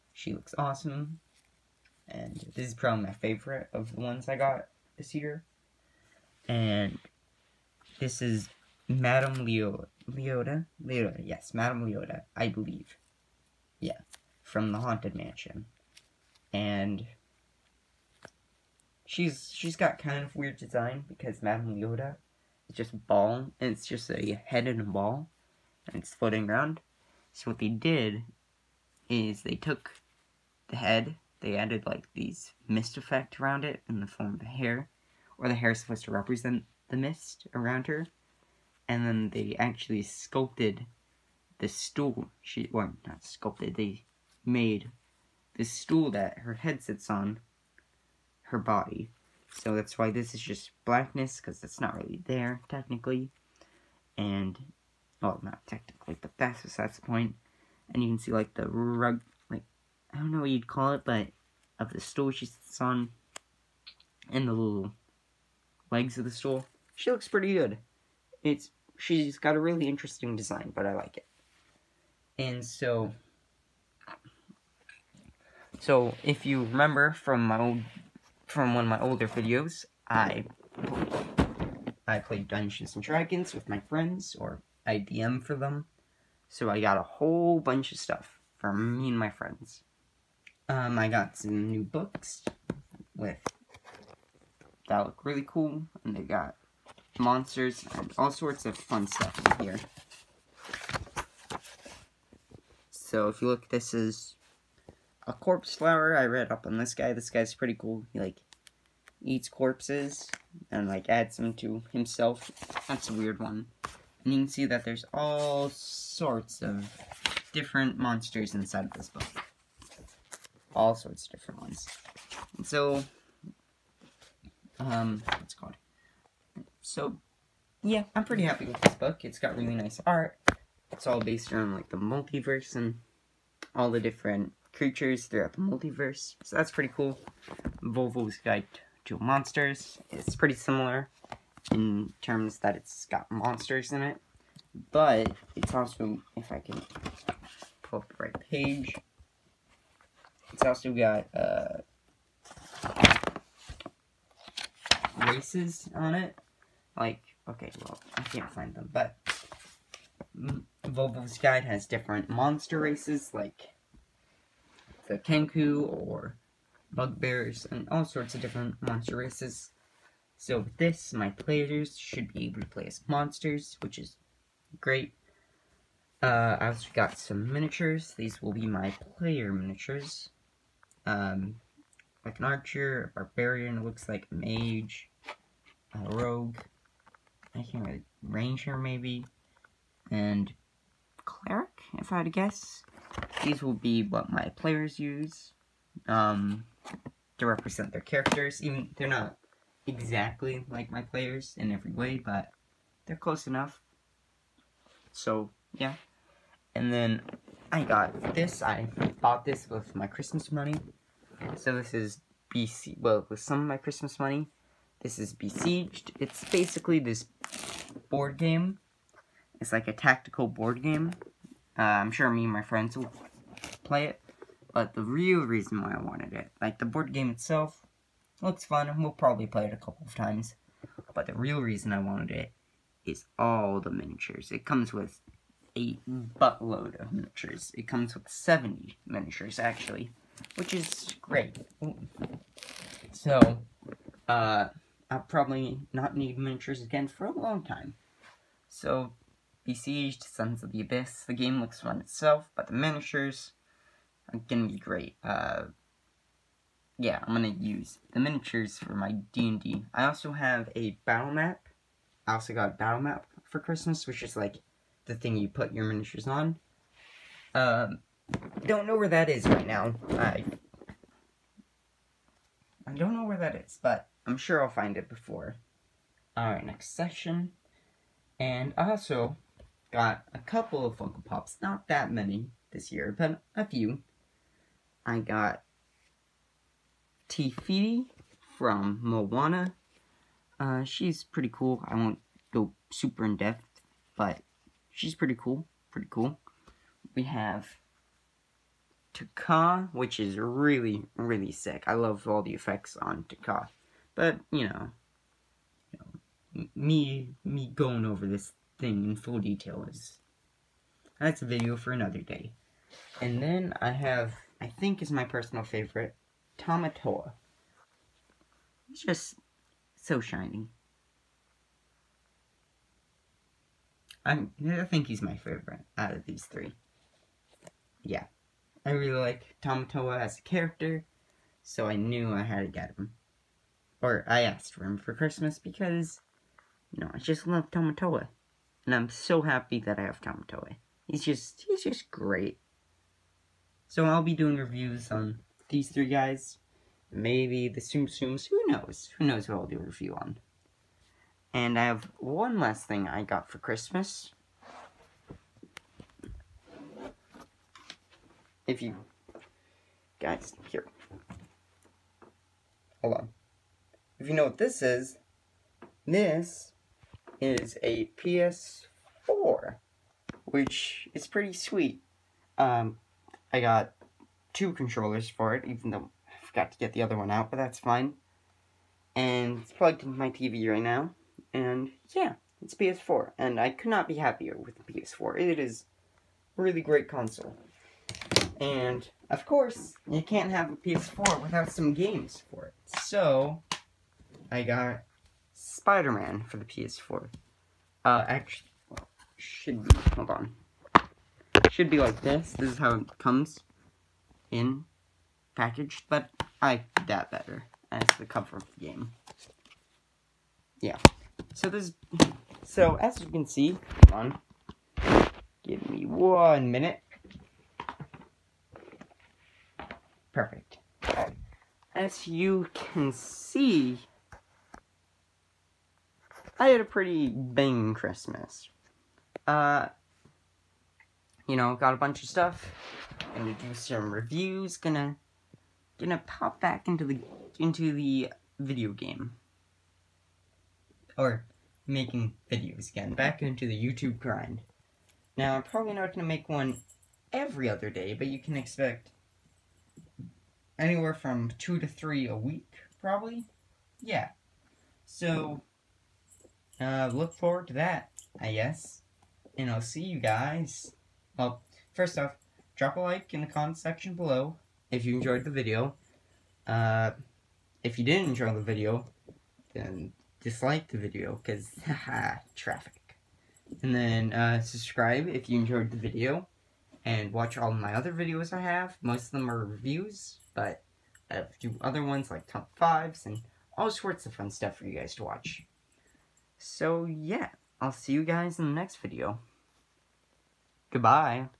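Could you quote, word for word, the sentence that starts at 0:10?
Leota, yes, Madame Leota, I believe.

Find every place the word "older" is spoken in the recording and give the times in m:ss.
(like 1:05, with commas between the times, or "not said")
1:18.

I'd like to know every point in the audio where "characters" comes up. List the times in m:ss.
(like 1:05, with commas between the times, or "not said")
3:18, 5:30.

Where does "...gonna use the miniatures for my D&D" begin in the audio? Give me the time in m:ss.
4:17.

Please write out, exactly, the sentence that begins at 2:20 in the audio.
It's pretty similar in terms that it's got monsters in it.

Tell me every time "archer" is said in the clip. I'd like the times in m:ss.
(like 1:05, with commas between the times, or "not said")
3:02.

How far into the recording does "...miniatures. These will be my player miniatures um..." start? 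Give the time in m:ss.
2:57.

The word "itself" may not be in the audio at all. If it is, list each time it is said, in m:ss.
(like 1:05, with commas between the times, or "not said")
3:47, 4:11.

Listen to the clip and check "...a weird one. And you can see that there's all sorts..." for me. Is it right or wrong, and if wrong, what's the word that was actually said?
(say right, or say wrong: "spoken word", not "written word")
right.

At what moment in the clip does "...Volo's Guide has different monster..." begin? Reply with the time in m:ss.
2:40.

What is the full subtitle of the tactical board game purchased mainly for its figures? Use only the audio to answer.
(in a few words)
Sons of the Abyss.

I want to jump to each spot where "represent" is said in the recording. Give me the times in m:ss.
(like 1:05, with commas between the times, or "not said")
0:36, 3:17.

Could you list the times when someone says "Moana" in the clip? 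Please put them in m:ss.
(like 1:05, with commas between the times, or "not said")
4:49.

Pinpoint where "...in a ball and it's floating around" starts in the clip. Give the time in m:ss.
0:24.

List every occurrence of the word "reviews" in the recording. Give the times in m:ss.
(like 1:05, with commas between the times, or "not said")
5:44, 5:49, 7:14, 7:59.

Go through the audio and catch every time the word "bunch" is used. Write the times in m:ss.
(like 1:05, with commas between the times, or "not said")
1:27, 7:11.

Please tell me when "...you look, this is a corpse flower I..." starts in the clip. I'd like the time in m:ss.
1:43.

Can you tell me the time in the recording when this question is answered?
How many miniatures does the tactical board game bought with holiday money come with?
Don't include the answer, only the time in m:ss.
3:58.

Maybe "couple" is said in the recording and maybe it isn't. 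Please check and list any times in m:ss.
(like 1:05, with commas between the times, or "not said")
3:49, 4:40.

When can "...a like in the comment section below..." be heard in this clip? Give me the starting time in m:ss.
7:42.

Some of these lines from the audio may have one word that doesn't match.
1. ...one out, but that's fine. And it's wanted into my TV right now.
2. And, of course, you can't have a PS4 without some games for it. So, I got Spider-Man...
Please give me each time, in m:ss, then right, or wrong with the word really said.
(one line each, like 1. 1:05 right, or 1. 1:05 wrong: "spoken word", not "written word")
1. 6:17 wrong: "plugged", not "wanted"
2. 6:28 right.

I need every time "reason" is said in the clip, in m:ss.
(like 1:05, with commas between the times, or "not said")
3:45, 3:51.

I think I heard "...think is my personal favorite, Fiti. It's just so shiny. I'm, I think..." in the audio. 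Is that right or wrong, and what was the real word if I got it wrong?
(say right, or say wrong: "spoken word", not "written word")
wrong: "Tamatoa", not "Fiti".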